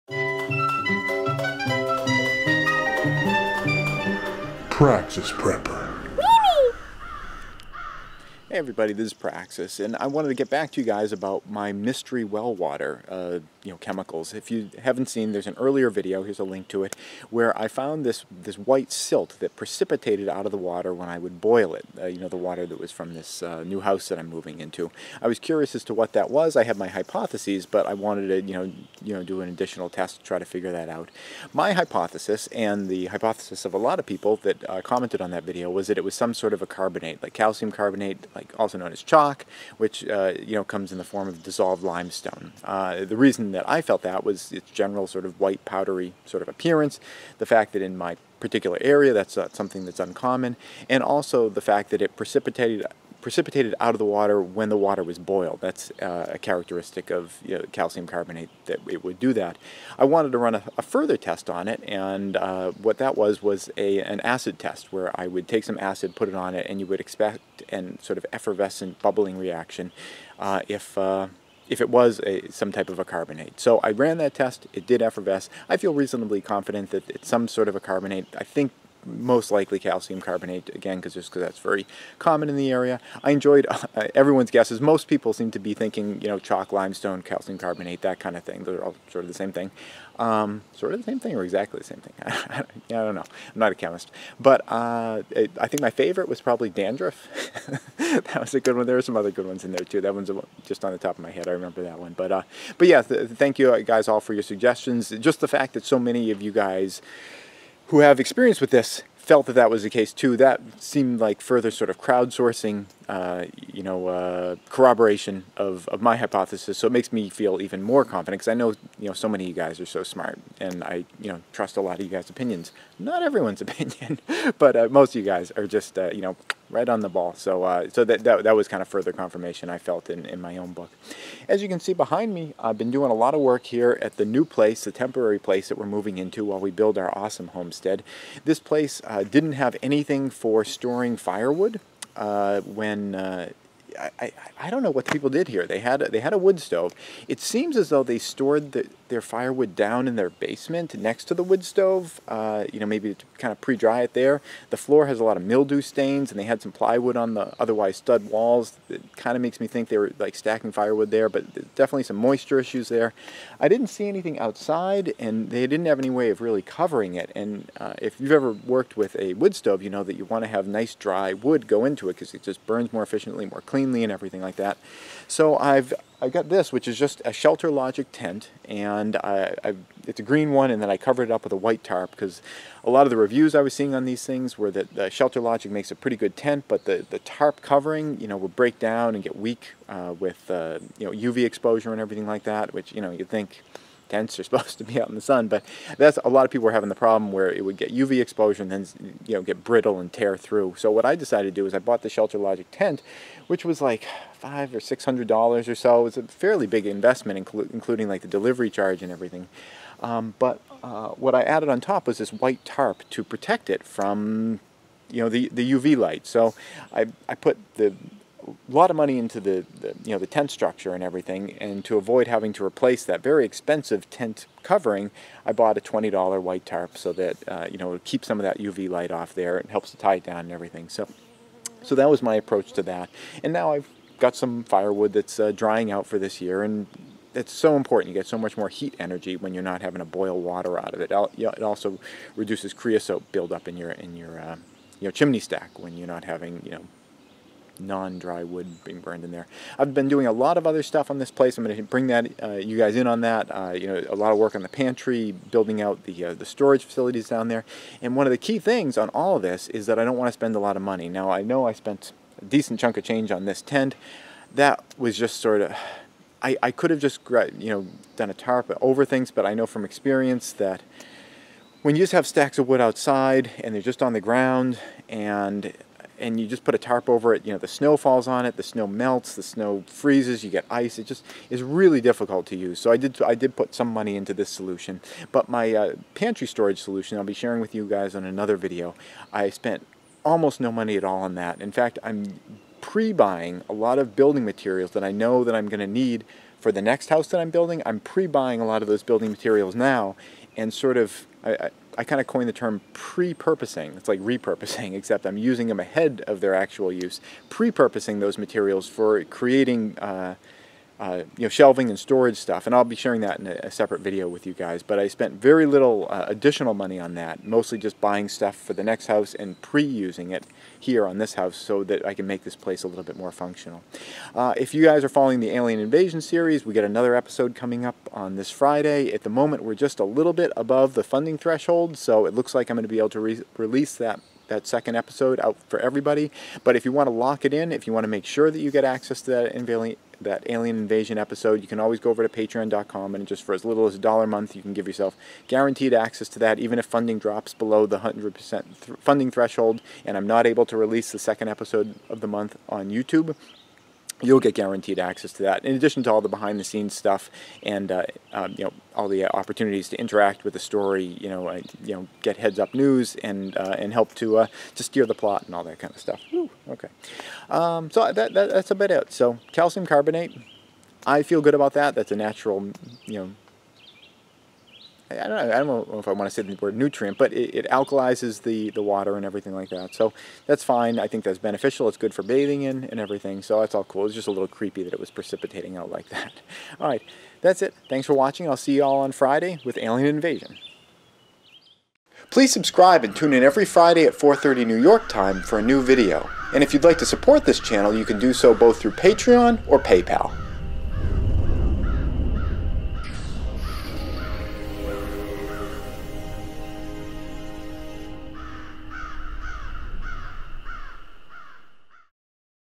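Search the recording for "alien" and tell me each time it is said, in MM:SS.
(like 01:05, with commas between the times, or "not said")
05:25, 05:40, 06:29.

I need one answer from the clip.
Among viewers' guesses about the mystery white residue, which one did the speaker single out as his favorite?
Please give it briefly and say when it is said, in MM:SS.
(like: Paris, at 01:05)
dandruff, at 01:36.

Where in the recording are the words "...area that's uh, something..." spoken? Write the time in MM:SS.
00:48.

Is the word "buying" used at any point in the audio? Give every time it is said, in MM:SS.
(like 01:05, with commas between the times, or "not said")
04:52, 04:57, 05:17.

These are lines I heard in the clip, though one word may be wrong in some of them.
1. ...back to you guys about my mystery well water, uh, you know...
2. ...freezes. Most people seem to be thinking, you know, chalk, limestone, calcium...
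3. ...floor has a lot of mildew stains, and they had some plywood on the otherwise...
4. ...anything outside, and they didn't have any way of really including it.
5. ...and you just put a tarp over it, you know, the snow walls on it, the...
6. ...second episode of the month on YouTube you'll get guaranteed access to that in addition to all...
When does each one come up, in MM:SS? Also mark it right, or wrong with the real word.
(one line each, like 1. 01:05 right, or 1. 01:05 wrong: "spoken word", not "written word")
1. 00:10 right
2. 01:24 wrong: "guesses", not "freezes"
3. 02:34 right
4. 02:44 wrong: "covering", not "including"
5. 04:36 wrong: "falls", not "walls"
6. 05:51 right.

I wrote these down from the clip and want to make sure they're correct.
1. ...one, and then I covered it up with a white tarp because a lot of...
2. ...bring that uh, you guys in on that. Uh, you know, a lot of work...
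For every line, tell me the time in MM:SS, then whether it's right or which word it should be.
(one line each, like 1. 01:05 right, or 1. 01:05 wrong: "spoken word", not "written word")
1. 03:00 right
2. 04:11 right.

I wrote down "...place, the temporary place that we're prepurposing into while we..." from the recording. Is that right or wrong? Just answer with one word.
wrong.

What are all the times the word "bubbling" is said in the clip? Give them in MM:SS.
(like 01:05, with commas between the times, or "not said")
01:09.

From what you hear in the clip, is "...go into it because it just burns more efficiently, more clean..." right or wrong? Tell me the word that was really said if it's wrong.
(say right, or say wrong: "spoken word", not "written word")
right.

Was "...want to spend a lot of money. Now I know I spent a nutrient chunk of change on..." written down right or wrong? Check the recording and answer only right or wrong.
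wrong.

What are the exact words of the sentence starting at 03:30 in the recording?
Um, but uh, what I added on top was this white tarp to protect it from you know the the UV light.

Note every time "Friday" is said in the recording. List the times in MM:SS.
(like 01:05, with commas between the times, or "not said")
05:28, 06:29, 06:33.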